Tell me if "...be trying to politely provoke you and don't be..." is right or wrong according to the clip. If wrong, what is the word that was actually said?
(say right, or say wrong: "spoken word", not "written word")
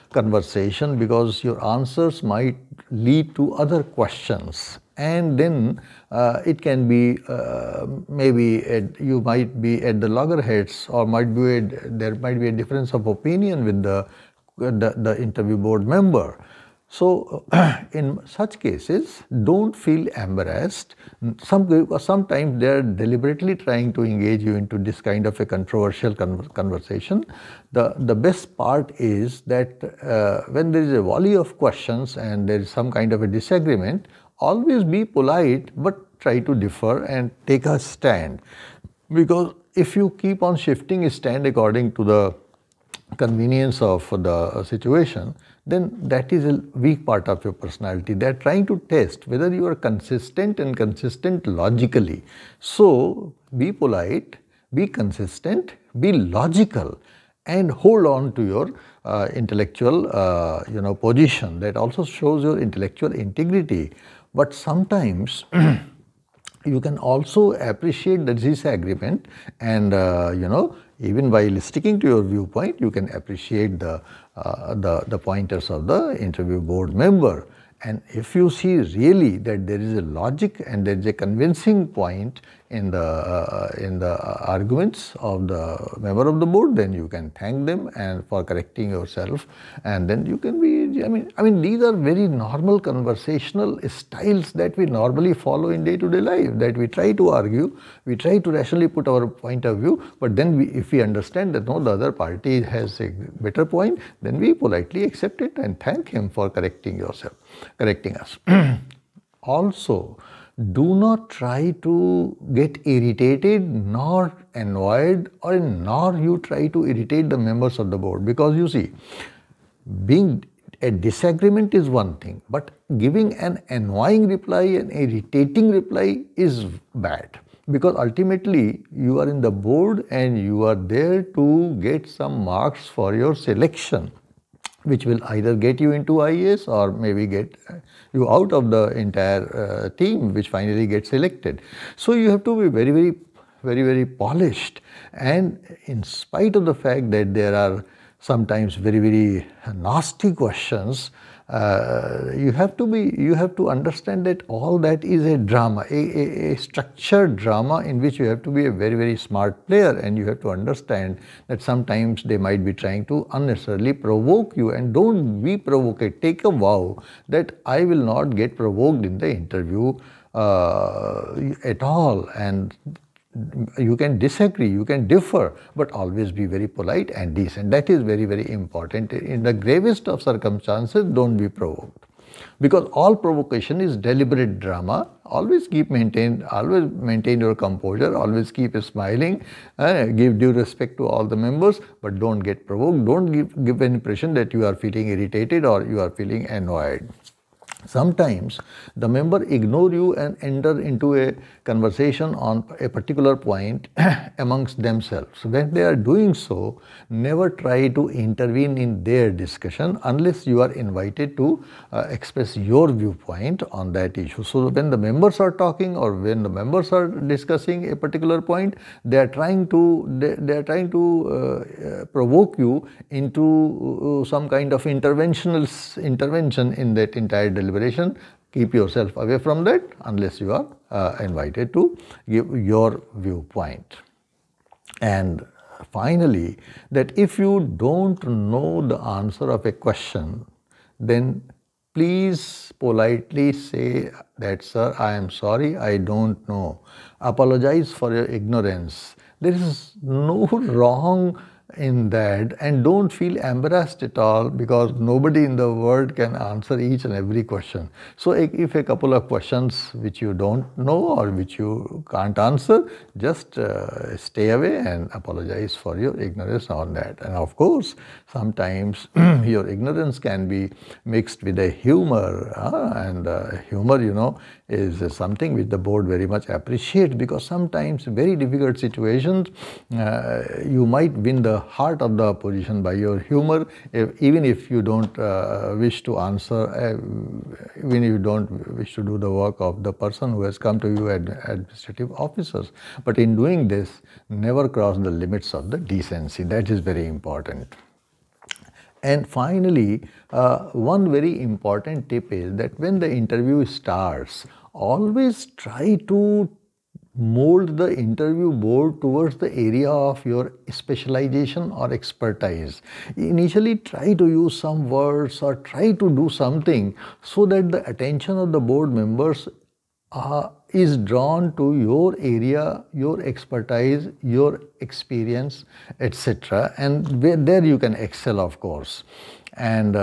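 wrong: "unnecessarily", not "politely".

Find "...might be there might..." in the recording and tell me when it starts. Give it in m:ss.
0:11.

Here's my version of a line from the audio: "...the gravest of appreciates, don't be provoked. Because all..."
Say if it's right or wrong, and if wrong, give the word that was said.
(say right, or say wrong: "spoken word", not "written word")
wrong: "circumstances", not "appreciates".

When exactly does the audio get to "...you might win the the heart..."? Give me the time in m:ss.
4:40.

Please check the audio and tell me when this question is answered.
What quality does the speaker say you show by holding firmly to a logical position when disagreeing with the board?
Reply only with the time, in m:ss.
1:02.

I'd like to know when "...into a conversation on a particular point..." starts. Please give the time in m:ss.
3:20.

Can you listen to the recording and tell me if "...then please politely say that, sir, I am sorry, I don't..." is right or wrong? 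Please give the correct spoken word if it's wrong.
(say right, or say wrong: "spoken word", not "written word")
right.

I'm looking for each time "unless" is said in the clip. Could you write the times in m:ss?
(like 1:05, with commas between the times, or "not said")
3:30, 3:50.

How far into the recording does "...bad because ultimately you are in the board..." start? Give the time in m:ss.
2:06.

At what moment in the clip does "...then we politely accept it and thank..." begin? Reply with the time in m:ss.
1:44.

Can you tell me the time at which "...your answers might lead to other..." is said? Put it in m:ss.
0:01.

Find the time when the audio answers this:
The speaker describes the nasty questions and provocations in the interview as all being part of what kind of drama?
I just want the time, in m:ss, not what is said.
2:36.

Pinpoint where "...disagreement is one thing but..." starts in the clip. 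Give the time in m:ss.
2:00.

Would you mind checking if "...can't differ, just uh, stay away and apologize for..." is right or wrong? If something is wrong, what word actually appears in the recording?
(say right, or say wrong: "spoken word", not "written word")
wrong: "answer", not "differ".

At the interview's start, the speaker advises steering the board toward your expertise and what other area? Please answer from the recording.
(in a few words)
specialization.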